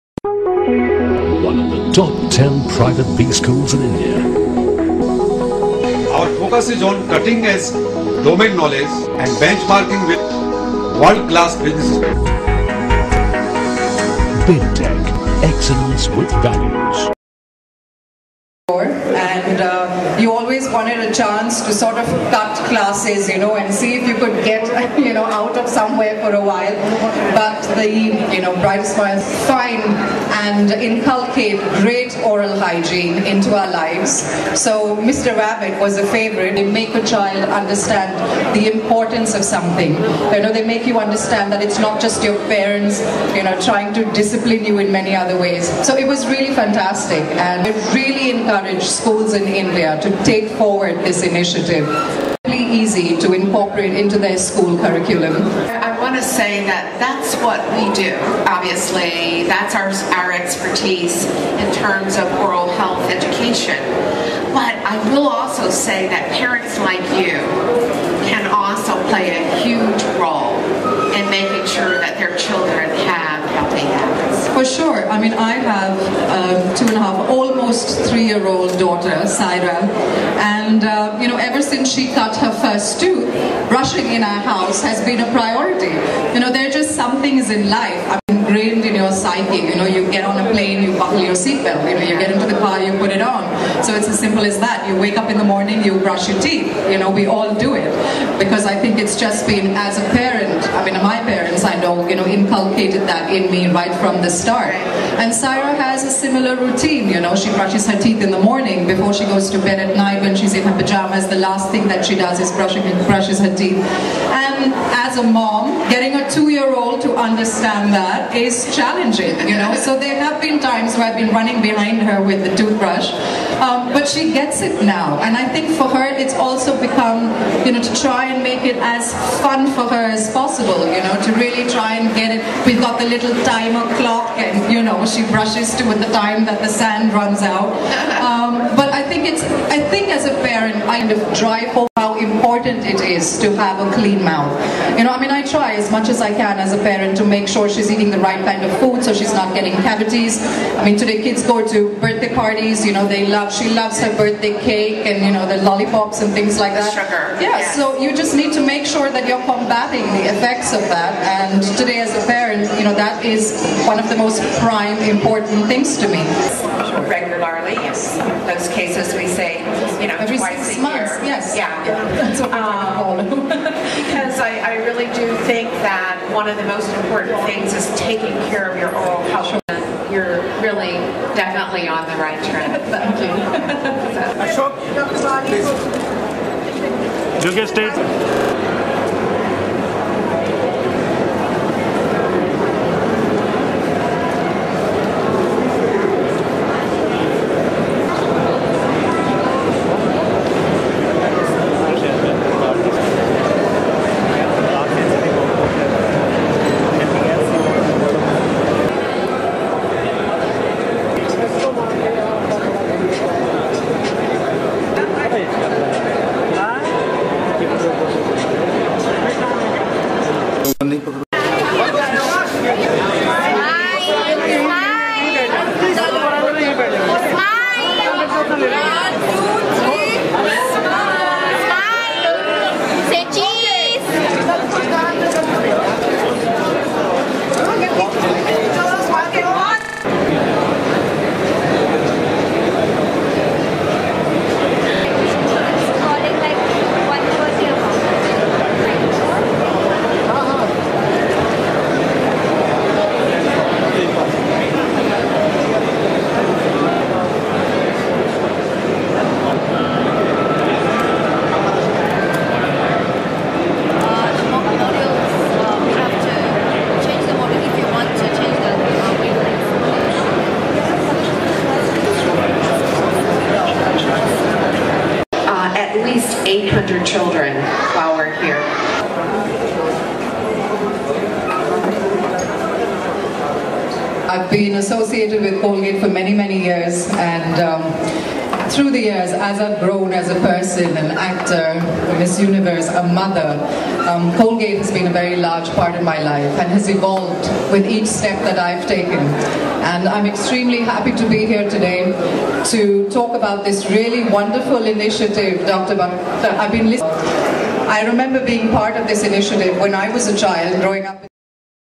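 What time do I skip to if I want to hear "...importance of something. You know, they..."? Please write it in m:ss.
0:38.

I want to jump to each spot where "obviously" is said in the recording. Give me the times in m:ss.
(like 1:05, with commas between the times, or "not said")
0:58.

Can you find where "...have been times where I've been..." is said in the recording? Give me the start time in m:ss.
2:00.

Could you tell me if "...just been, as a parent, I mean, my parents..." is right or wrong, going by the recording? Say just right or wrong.
right.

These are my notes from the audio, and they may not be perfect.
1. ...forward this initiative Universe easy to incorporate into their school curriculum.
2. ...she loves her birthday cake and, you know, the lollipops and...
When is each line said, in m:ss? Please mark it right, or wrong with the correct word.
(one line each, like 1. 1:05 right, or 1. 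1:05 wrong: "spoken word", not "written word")
1. 0:50 wrong: "Really", not "Universe"
2. 2:33 right.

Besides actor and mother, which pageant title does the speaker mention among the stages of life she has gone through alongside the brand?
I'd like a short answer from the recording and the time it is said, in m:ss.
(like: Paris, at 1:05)
Miss Universe, at 4:52.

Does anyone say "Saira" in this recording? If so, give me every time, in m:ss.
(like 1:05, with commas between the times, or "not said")
1:19, 1:45.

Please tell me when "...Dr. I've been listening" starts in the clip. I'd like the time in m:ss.
5:05.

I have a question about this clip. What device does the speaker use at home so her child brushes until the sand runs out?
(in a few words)
timer clock.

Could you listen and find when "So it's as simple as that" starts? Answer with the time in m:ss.
1:33.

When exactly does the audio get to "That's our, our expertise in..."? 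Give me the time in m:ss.
0:59.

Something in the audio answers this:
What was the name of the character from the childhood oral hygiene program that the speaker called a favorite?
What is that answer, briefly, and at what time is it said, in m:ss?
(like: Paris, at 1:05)
Mr. Rabbit, at 0:34.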